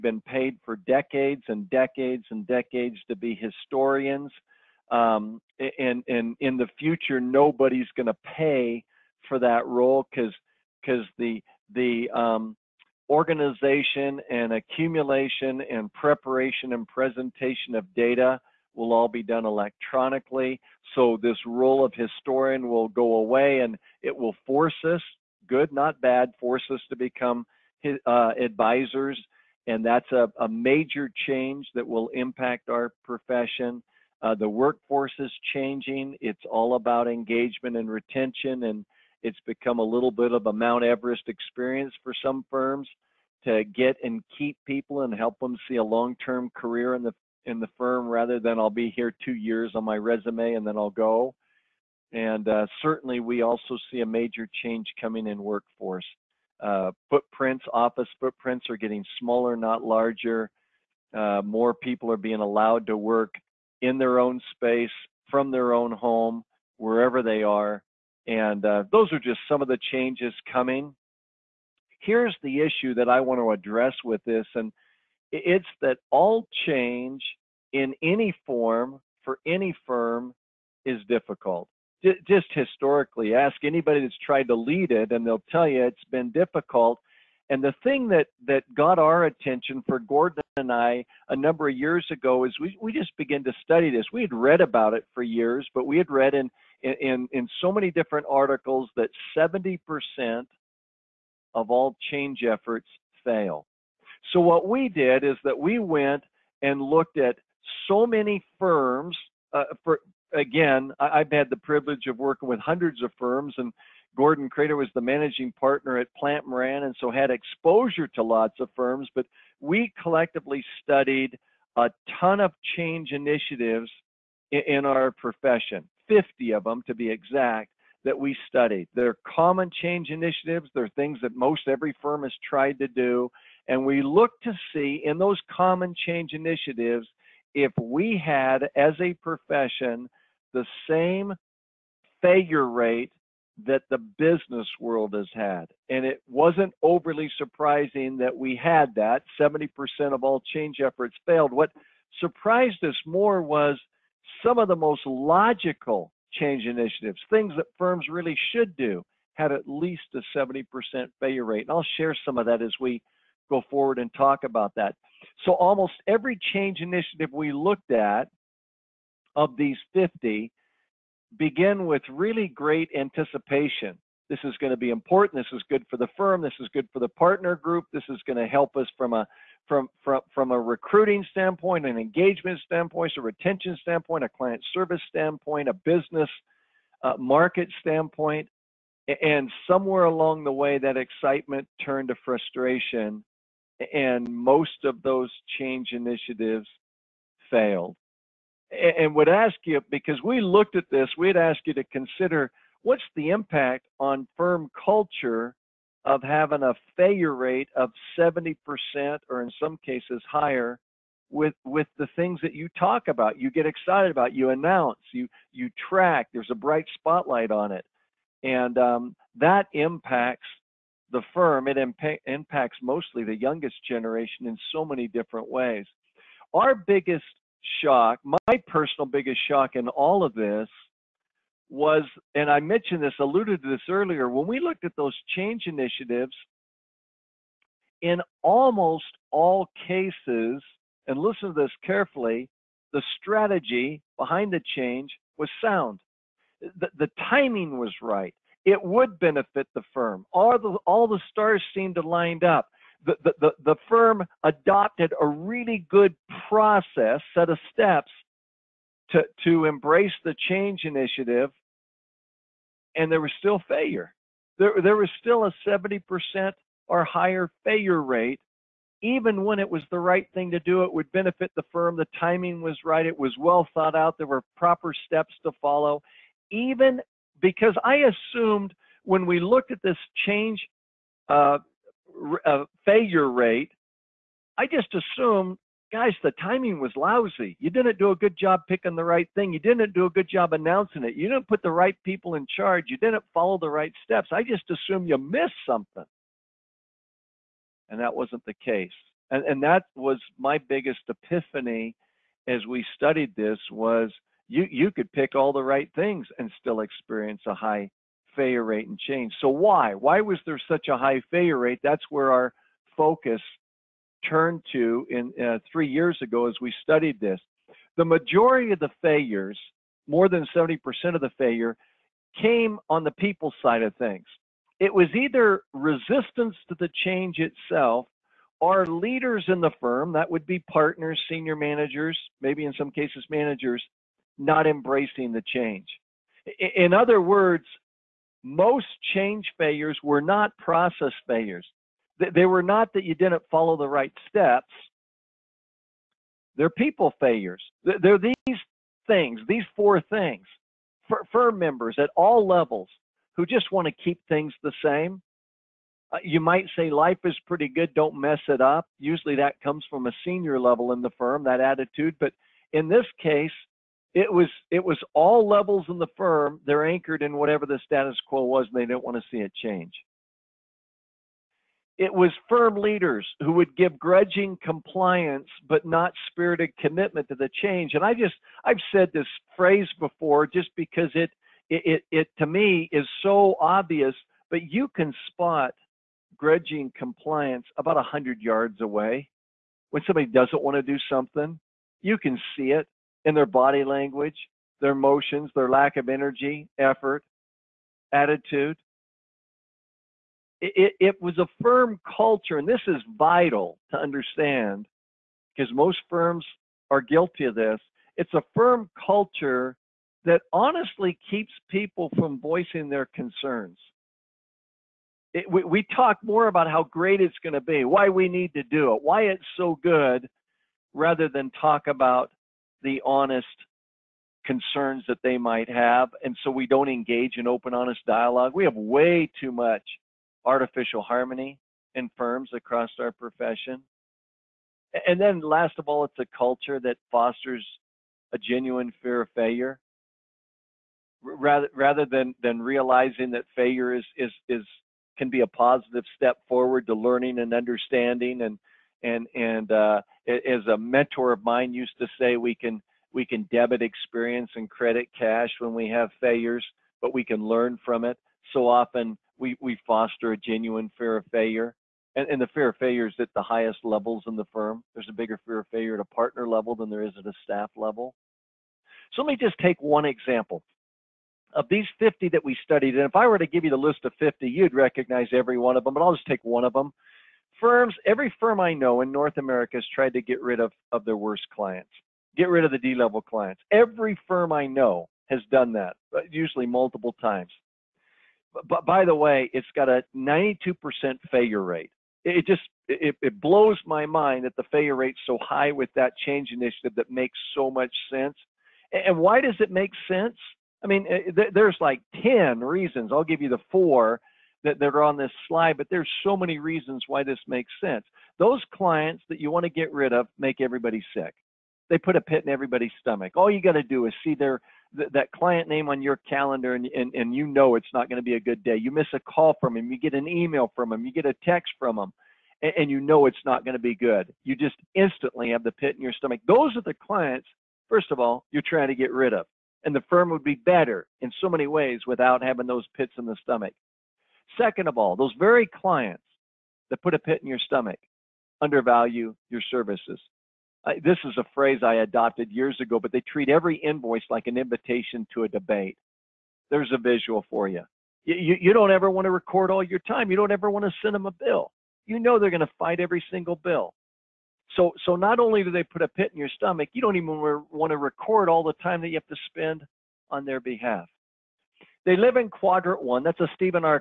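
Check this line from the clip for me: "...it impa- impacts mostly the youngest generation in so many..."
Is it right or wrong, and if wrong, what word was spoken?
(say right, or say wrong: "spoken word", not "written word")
right.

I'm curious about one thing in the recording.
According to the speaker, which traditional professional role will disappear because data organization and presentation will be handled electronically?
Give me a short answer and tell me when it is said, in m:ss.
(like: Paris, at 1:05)
Historian, at 0:21.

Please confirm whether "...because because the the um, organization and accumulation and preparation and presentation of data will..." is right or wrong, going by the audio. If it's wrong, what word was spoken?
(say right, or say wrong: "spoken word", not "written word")
right.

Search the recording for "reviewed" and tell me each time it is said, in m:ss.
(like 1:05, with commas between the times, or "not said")
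not said.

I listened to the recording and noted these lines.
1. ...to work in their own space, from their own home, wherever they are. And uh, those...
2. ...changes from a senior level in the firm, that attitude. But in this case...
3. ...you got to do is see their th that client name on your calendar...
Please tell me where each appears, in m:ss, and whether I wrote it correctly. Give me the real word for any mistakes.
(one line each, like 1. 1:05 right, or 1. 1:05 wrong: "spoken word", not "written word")
1. 1:02 right
2. 5:59 wrong: "comes", not "changes"
3. 8:33 right.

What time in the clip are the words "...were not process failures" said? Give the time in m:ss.
5:40.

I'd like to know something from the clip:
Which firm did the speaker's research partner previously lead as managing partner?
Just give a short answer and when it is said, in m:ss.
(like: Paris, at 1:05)
Plante Moran, at 1:56.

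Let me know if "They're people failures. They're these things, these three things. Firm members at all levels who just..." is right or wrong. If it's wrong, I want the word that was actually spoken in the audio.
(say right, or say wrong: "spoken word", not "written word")
wrong: "four", not "three".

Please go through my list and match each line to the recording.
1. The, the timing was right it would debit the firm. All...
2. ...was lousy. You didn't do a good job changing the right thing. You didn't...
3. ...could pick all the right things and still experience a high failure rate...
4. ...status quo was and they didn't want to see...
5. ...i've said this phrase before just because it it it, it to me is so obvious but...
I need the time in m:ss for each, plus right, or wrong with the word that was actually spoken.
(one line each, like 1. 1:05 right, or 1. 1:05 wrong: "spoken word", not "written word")
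1. 4:06 wrong: "benefit", not "debit"
2. 4:46 wrong: "picking", not "changing"
3. 5:04 right
4. 6:07 right
5. 6:18 right.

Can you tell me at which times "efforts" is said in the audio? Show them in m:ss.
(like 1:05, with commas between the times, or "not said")
1:42, 2:30, 6:36.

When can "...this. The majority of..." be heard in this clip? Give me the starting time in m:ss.
5:17.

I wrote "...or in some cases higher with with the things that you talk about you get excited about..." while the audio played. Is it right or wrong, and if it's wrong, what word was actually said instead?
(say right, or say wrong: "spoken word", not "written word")
right.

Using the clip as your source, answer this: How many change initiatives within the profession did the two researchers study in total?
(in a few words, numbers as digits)
50.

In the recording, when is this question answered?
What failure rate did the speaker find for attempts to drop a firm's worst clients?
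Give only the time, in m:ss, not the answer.
8:10.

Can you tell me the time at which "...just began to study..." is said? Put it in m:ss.
1:32.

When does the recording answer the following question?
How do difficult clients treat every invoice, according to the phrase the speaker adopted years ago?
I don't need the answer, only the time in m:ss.
9:04.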